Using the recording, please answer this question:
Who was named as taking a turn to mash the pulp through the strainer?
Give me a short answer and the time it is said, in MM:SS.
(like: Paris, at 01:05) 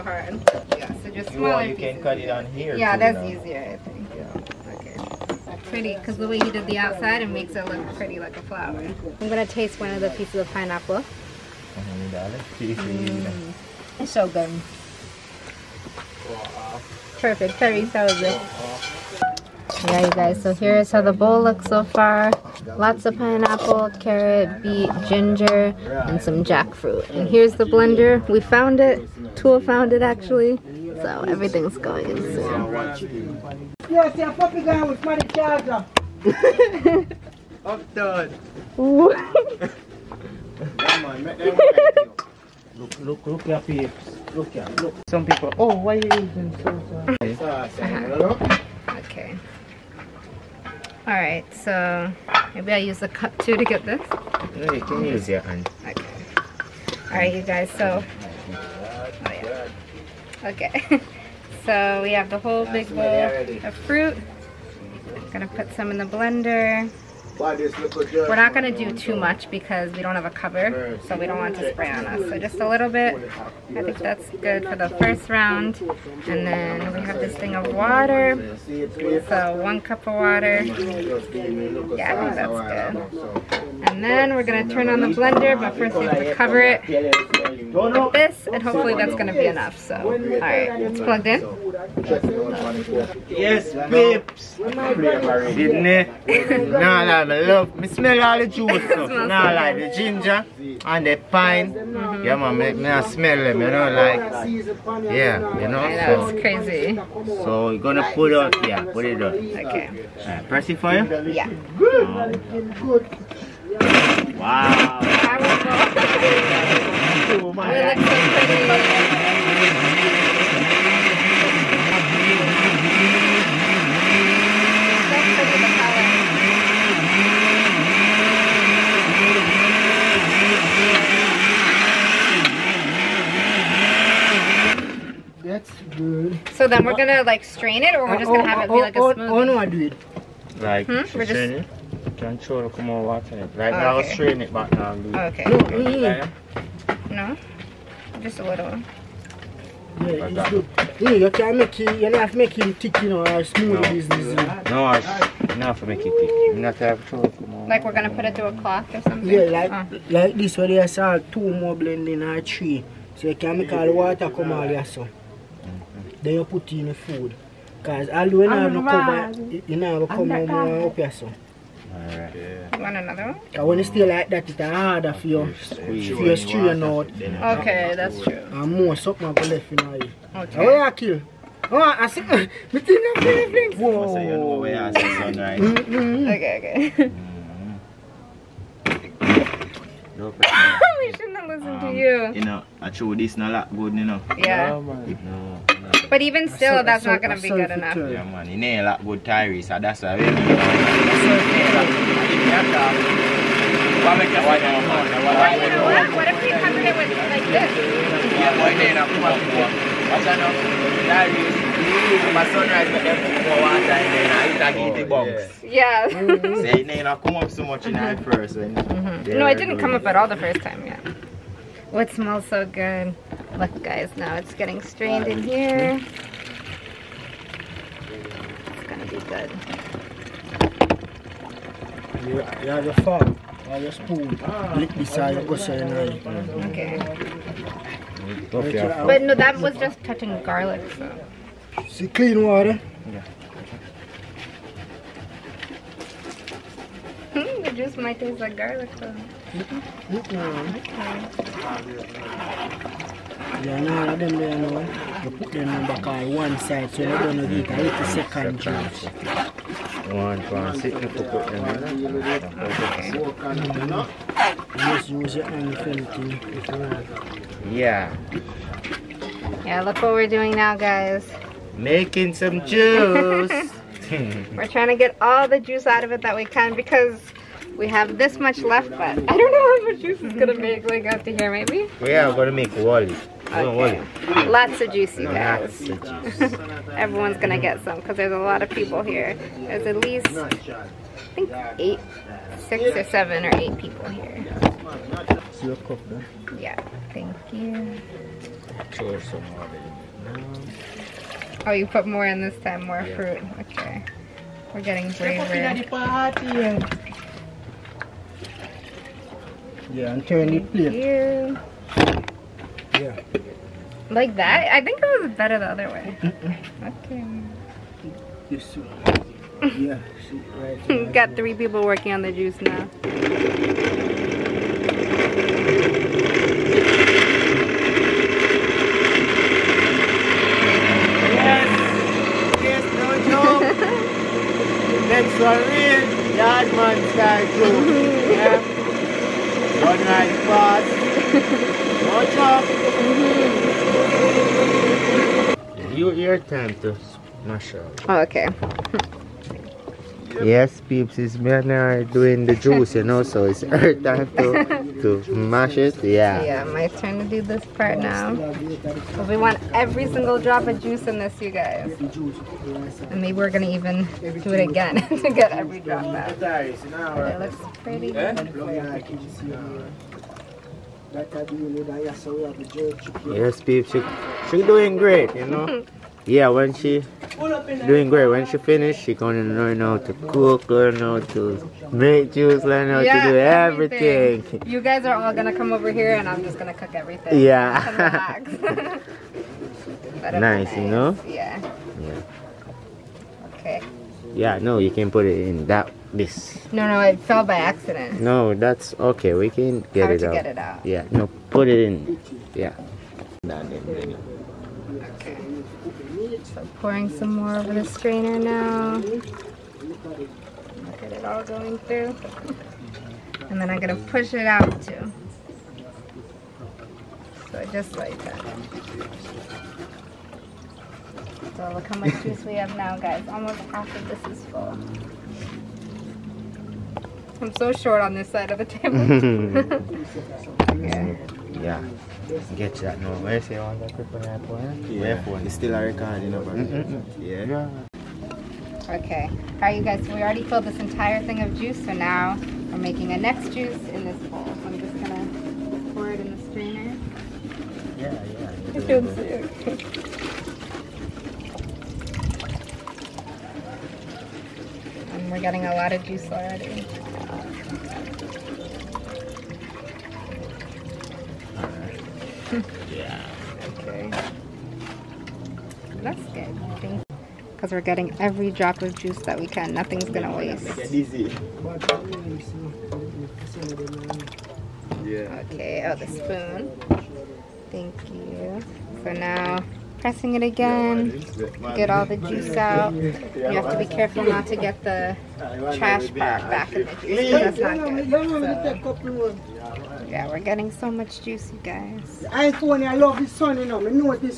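Myanmar, at 05:51.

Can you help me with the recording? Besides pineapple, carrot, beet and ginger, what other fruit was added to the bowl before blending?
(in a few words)
jackfruit.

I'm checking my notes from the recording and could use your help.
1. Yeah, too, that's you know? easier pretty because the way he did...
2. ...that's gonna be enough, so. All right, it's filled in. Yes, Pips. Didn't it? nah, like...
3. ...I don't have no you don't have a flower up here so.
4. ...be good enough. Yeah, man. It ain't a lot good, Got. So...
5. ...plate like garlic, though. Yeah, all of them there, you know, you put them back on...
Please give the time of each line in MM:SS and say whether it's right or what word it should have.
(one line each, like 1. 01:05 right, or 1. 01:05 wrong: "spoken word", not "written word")
1. 00:02 right
2. 01:28 wrong: "plugged", not "filled"
3. 02:48 wrong: "cover", not "flower"
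4. 03:17 wrong: "Tyrese", not "Got"
5. 04:08 wrong: "taste", not "plate".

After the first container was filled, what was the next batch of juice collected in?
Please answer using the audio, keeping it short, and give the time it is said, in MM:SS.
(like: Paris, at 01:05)
this bowl, at 07:24.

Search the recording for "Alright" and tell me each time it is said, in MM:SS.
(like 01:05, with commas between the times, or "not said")
00:51, 00:57, 02:51, 07:19.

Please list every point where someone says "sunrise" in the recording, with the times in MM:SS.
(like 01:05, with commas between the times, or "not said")
03:05, 03:32.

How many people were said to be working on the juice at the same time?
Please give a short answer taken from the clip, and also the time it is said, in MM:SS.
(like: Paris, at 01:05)
3, at 05:21.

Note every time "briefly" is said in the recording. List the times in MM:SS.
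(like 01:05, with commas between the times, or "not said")
not said.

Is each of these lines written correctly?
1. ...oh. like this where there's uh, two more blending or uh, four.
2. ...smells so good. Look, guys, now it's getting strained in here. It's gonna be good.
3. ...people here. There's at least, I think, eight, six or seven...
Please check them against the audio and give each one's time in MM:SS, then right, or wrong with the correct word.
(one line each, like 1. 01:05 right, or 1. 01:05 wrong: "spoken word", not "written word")
1. 02:39 wrong: "three", not "four"
2. 03:42 right
3. 04:48 right.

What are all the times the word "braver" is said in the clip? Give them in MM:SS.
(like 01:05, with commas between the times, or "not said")
05:05.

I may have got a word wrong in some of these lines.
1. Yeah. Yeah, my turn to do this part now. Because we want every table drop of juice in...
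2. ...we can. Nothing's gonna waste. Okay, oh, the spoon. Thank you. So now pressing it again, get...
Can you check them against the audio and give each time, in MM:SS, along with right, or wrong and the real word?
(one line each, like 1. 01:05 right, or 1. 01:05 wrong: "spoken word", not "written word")
1. 05:56 wrong: "single", not "table"
2. 07:49 right.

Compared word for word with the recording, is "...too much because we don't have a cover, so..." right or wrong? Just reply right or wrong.
right.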